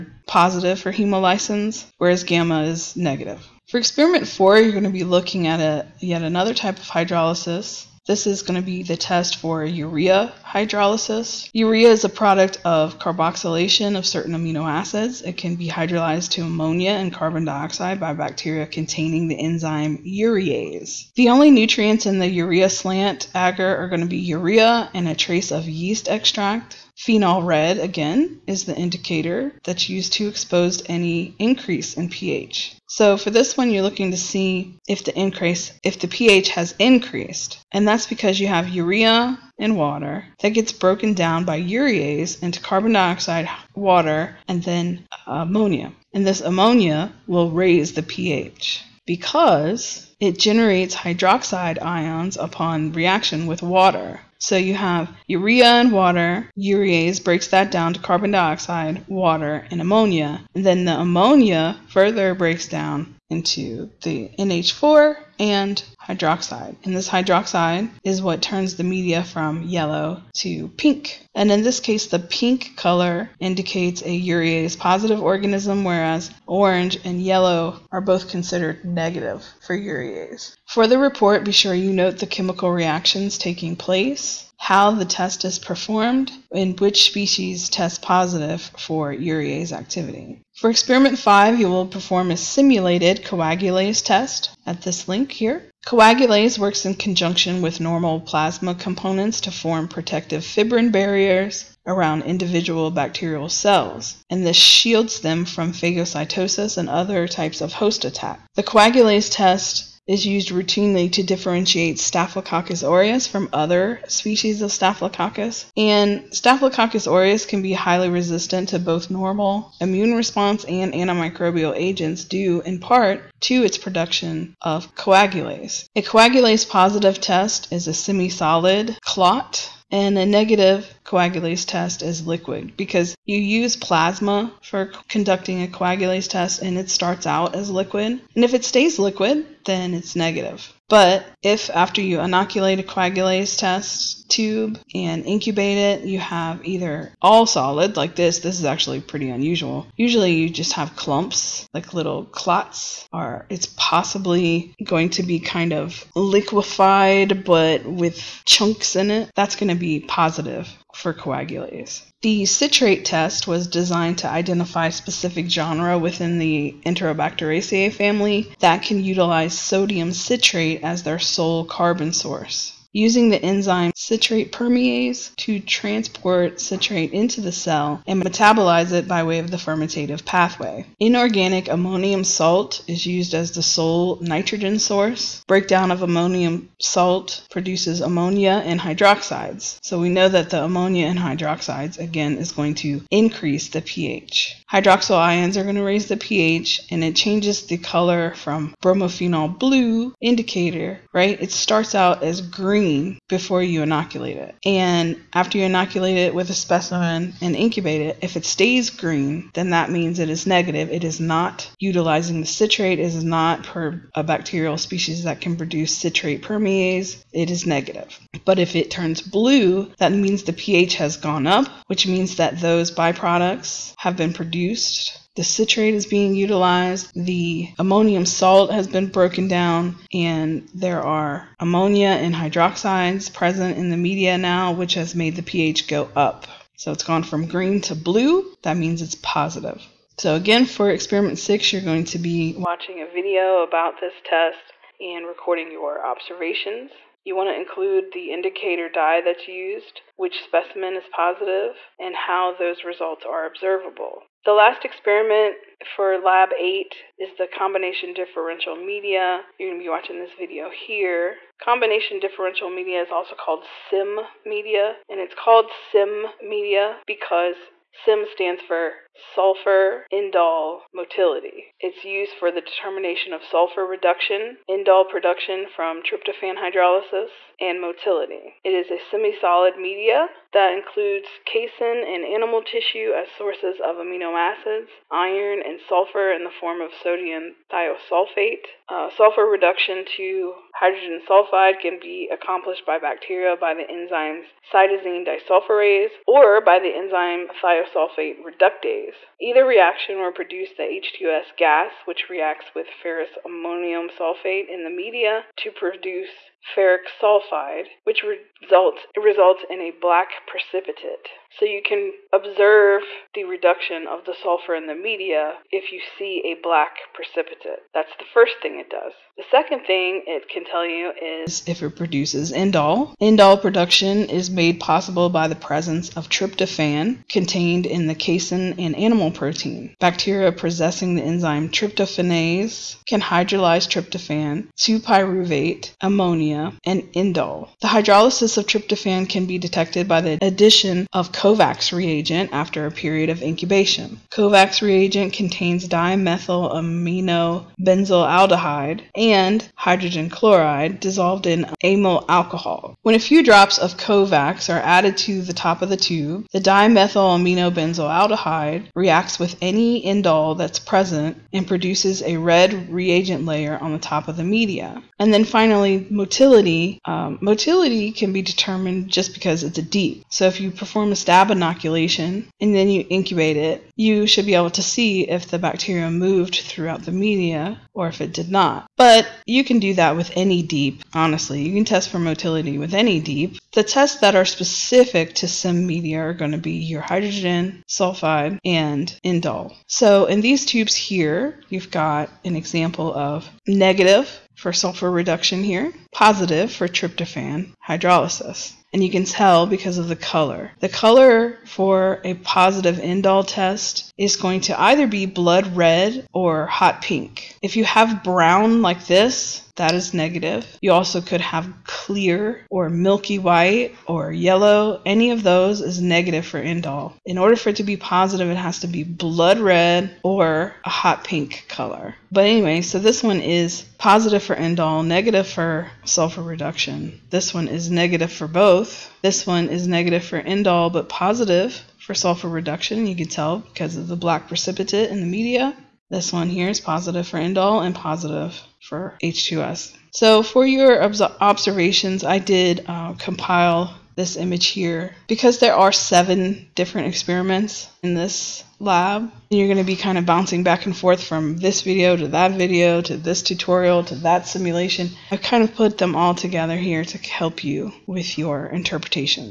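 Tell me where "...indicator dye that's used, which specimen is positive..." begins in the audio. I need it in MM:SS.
04:08.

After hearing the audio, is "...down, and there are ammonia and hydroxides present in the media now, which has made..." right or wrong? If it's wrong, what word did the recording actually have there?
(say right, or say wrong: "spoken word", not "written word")
right.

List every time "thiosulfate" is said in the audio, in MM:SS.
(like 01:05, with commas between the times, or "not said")
04:47, 04:57.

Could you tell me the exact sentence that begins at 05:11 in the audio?
So you can observe the reduction of the sulfur in the media if you see a black precipitate.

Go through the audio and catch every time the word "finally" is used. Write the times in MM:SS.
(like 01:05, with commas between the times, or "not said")
06:05.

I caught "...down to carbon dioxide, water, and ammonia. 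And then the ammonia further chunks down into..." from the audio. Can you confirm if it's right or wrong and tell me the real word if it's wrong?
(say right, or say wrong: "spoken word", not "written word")
wrong: "breaks", not "chunks".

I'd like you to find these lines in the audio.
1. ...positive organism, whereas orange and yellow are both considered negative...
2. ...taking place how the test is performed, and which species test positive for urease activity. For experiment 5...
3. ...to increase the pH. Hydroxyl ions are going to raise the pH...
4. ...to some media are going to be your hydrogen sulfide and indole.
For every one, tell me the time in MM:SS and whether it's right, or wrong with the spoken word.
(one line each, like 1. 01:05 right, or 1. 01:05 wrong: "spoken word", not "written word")
1. 01:14 right
2. 01:23 right
3. 03:12 right
4. 06:25 right.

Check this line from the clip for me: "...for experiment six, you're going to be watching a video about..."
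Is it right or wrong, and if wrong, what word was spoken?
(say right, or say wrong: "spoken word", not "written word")
right.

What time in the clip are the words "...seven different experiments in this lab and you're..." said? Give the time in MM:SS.
07:25.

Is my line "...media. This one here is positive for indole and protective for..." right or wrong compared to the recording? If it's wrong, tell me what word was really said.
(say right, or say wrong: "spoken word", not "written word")
wrong: "positive", not "protective".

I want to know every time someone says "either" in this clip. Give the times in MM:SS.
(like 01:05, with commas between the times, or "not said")
02:26, 04:59, 06:44.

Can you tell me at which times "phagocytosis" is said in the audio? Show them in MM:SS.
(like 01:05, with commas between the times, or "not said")
01:45.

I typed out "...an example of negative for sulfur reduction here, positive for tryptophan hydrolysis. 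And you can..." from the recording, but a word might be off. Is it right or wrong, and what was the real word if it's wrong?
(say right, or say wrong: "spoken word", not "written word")
right.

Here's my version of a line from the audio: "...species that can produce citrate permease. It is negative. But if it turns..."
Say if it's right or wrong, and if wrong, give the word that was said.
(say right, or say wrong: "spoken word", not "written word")
right.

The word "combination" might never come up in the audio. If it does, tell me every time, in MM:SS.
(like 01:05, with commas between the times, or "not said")
04:17, 04:21.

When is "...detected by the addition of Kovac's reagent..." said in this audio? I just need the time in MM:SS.
05:39.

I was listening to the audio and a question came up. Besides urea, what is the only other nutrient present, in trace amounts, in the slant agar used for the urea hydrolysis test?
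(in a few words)
Yeast extract.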